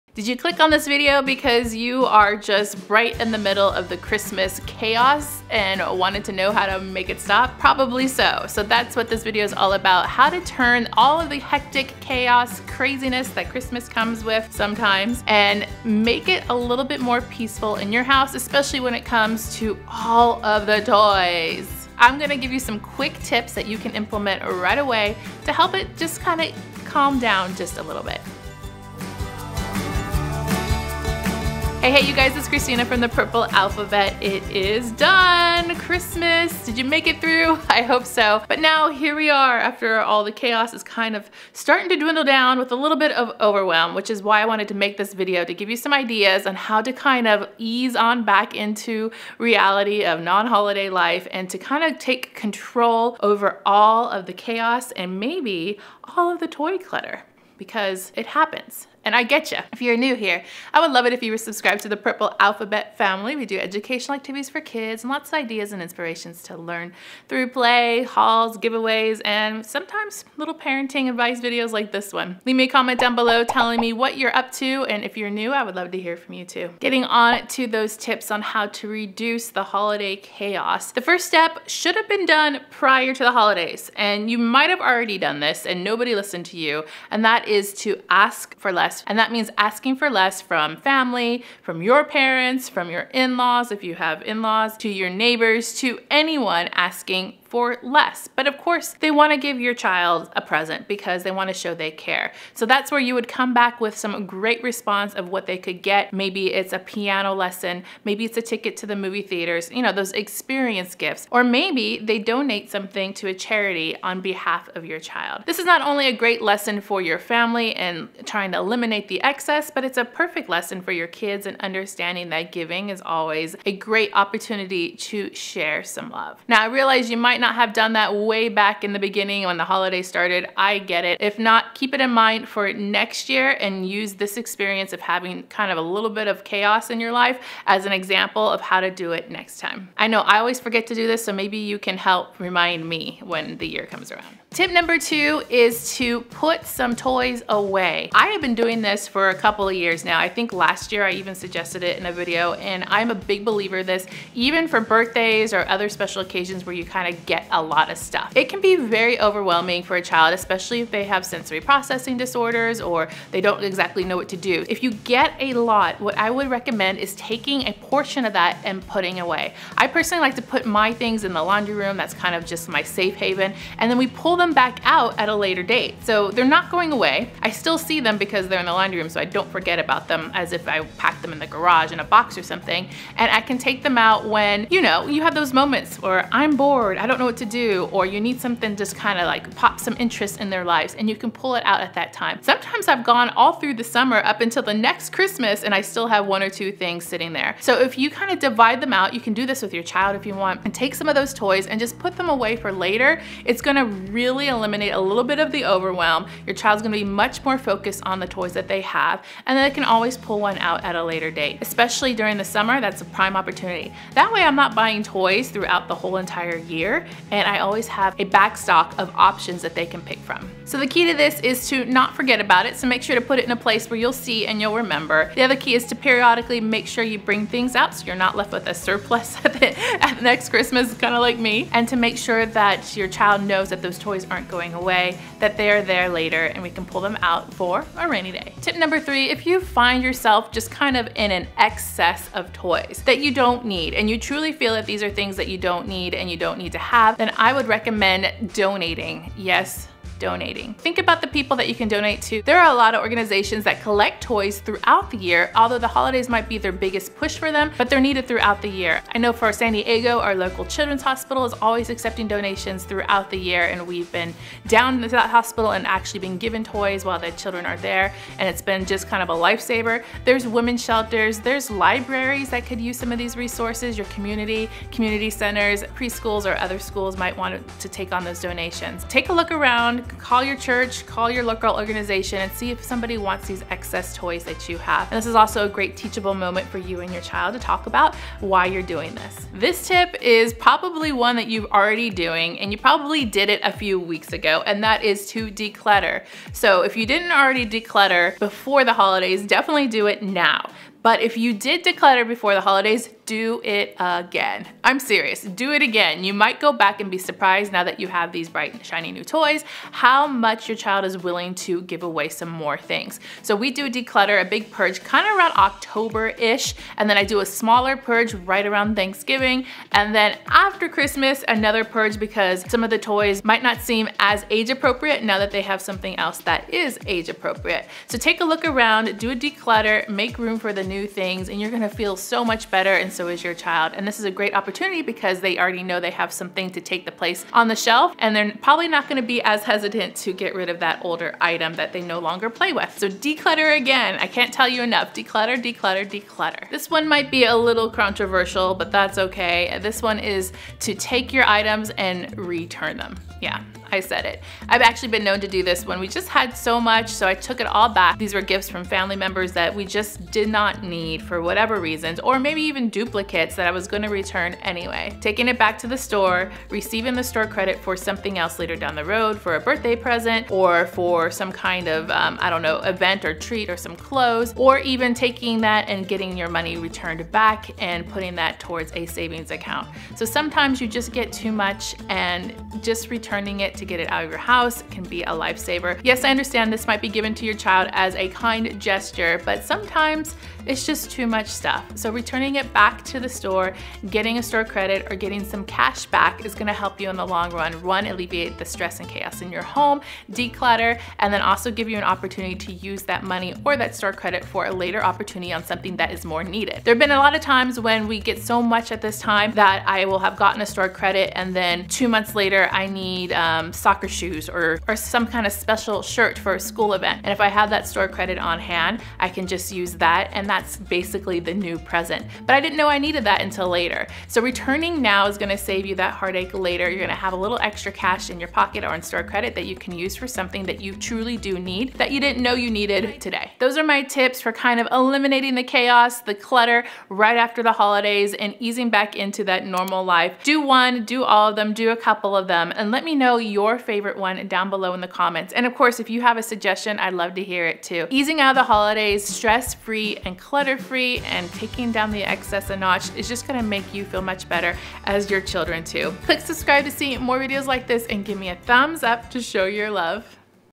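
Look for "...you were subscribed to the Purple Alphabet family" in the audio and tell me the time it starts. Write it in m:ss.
1:01.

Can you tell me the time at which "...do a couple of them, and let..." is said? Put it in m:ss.
7:21.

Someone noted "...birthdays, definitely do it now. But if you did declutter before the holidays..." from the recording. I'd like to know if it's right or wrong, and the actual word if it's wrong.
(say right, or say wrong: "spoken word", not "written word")
wrong: "holidays", not "birthdays".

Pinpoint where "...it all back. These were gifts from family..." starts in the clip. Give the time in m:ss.
5:57.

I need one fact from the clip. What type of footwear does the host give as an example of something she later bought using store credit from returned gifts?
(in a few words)
Soccer shoes.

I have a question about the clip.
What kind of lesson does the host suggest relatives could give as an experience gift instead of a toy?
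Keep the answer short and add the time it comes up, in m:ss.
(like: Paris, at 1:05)
Piano lesson, at 1:46.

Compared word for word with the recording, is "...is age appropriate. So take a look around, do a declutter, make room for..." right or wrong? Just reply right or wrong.
right.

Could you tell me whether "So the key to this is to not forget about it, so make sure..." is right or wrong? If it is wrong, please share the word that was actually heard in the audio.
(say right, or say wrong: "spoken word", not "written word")
right.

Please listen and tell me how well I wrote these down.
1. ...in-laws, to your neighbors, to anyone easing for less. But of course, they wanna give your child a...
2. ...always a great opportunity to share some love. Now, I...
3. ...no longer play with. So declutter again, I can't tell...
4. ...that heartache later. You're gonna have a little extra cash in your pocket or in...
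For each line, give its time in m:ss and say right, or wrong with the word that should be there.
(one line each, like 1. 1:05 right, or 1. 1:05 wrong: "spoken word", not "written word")
1. 1:34 wrong: "asking", not "easing"
2. 2:03 right
3. 5:42 right
4. 7:05 right.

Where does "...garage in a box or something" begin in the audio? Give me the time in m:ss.
3:01.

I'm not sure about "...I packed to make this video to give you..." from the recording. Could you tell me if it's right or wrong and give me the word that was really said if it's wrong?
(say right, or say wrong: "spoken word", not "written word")
wrong: "wanted", not "packed".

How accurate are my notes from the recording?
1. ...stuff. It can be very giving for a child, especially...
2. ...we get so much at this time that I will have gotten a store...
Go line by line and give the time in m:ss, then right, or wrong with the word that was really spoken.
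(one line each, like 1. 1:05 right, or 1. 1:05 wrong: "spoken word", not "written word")
1. 2:37 wrong: "overwhelming", not "giving"
2. 6:48 right.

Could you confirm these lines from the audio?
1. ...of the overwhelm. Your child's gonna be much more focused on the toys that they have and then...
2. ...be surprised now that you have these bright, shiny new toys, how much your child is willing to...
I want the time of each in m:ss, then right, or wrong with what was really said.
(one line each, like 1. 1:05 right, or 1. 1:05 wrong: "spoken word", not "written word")
1. 3:25 right
2. 5:07 right.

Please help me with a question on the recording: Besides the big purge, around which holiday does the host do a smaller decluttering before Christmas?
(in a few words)
Thanksgiving.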